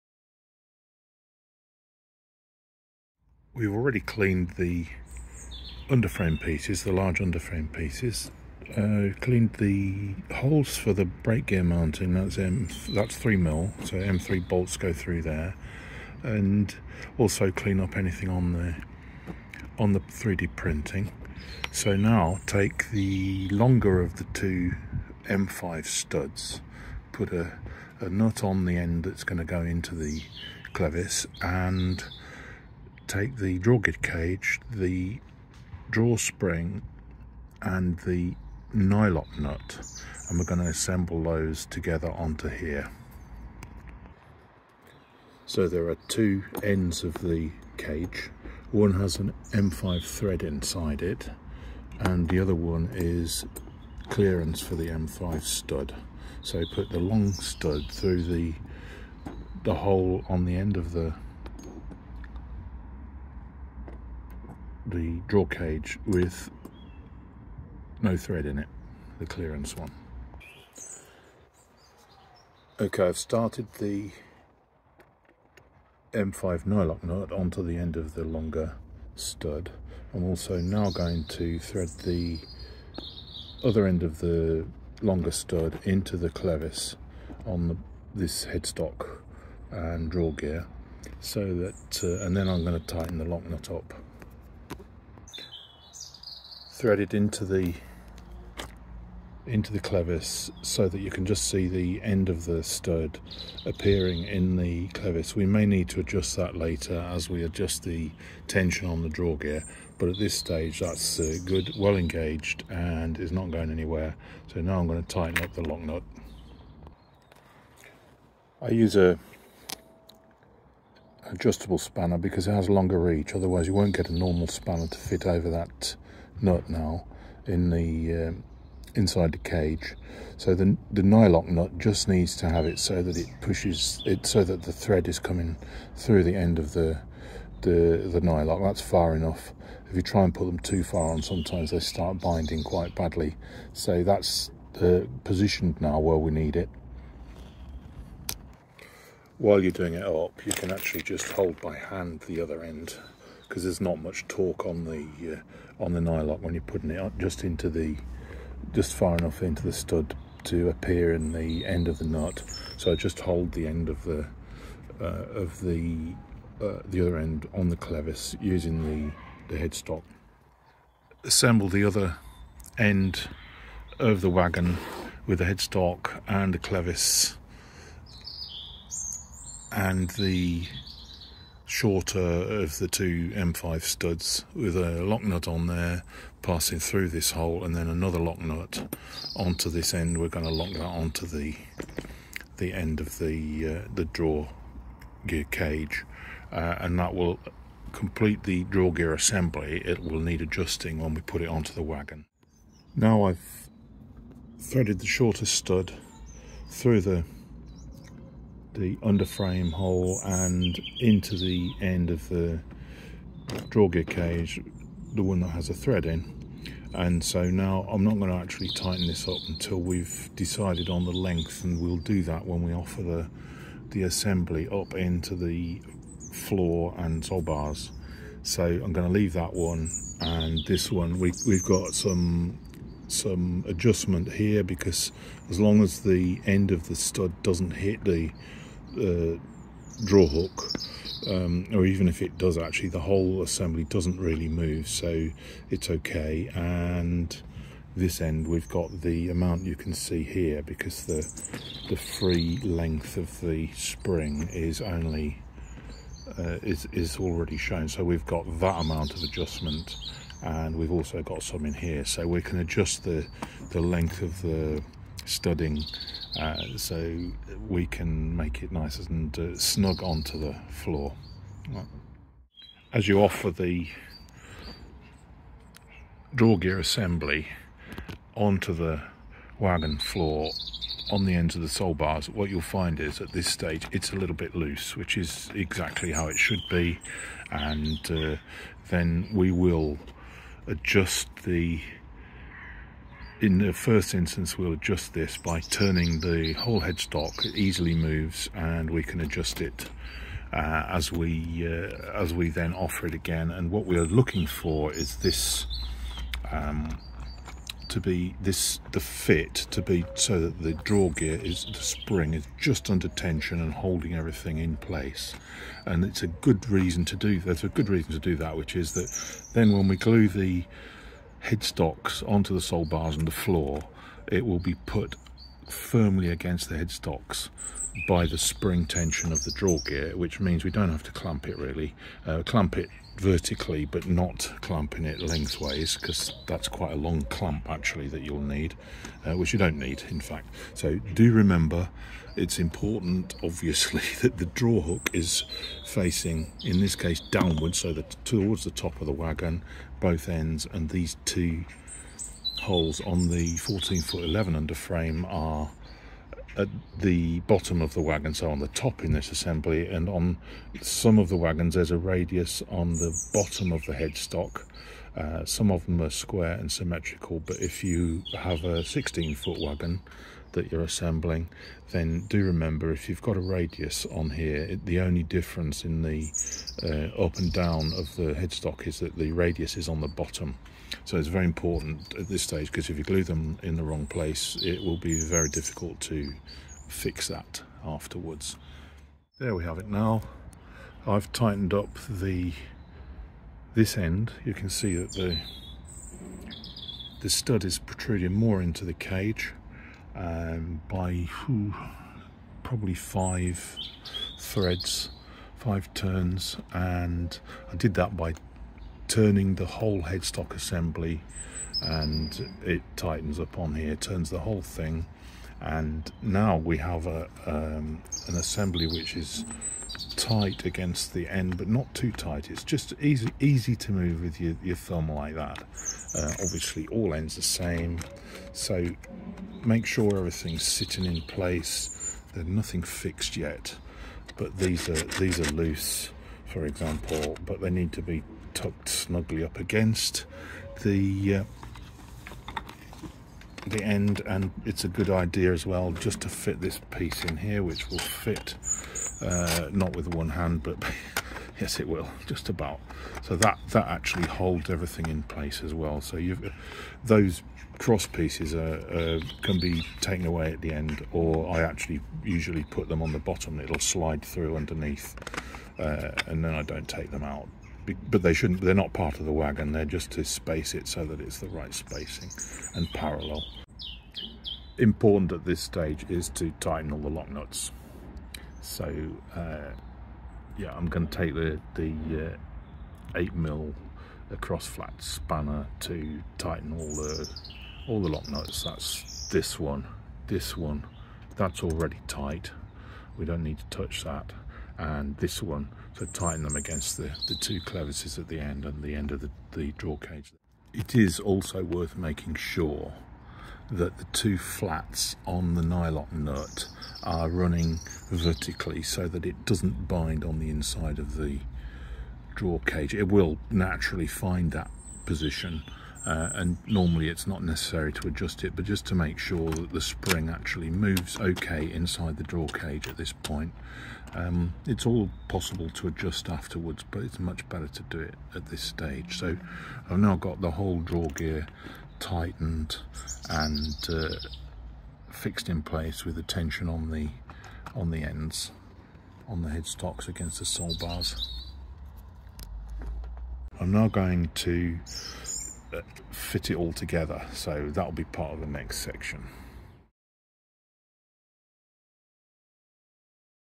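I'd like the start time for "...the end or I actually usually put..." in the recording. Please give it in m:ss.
7:40.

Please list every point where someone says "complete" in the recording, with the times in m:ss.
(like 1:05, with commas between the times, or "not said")
3:17.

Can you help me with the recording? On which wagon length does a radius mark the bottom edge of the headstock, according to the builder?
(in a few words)
16 foot.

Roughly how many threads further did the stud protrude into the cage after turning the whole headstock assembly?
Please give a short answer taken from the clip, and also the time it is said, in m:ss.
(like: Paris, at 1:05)
5, at 6:42.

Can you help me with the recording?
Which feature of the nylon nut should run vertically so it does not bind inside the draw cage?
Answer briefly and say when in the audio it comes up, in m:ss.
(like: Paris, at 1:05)
The two flats, at 8:23.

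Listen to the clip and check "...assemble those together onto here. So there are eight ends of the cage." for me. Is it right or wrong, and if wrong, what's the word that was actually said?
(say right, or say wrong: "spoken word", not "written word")
wrong: "two", not "eight".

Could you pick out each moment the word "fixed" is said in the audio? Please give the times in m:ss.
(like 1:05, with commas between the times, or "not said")
7:12, 8:55.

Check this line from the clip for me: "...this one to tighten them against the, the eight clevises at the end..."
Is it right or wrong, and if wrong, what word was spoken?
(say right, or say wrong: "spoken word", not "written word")
wrong: "two", not "eight".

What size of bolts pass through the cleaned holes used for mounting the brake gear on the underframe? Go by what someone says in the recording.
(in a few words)
M3.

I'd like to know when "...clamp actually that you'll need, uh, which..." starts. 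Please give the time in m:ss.
5:37.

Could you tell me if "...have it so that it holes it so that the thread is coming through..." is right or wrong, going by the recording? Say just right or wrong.
wrong.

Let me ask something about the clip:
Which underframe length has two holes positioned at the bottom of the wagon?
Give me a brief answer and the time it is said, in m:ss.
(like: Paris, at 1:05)
14 foot 11, at 5:53.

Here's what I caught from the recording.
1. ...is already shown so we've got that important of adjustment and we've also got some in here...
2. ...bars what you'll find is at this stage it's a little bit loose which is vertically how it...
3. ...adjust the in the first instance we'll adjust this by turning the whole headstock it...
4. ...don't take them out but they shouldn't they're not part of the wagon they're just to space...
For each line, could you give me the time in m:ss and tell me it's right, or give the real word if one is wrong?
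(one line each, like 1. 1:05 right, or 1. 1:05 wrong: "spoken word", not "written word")
1. 4:16 wrong: "amount", not "important"
2. 4:41 wrong: "exactly", not "vertically"
3. 4:50 right
4. 7:46 right.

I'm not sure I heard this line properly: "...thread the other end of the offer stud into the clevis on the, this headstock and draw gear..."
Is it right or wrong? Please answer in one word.
wrong.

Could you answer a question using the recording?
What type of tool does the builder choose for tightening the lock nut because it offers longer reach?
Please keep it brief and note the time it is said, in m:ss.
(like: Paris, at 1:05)
Adjustable spanner, at 2:01.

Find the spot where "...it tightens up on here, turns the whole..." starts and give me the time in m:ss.
6:52.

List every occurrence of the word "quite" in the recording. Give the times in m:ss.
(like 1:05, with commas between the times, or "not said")
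2:22, 5:36.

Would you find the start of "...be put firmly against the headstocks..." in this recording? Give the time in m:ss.
5:24.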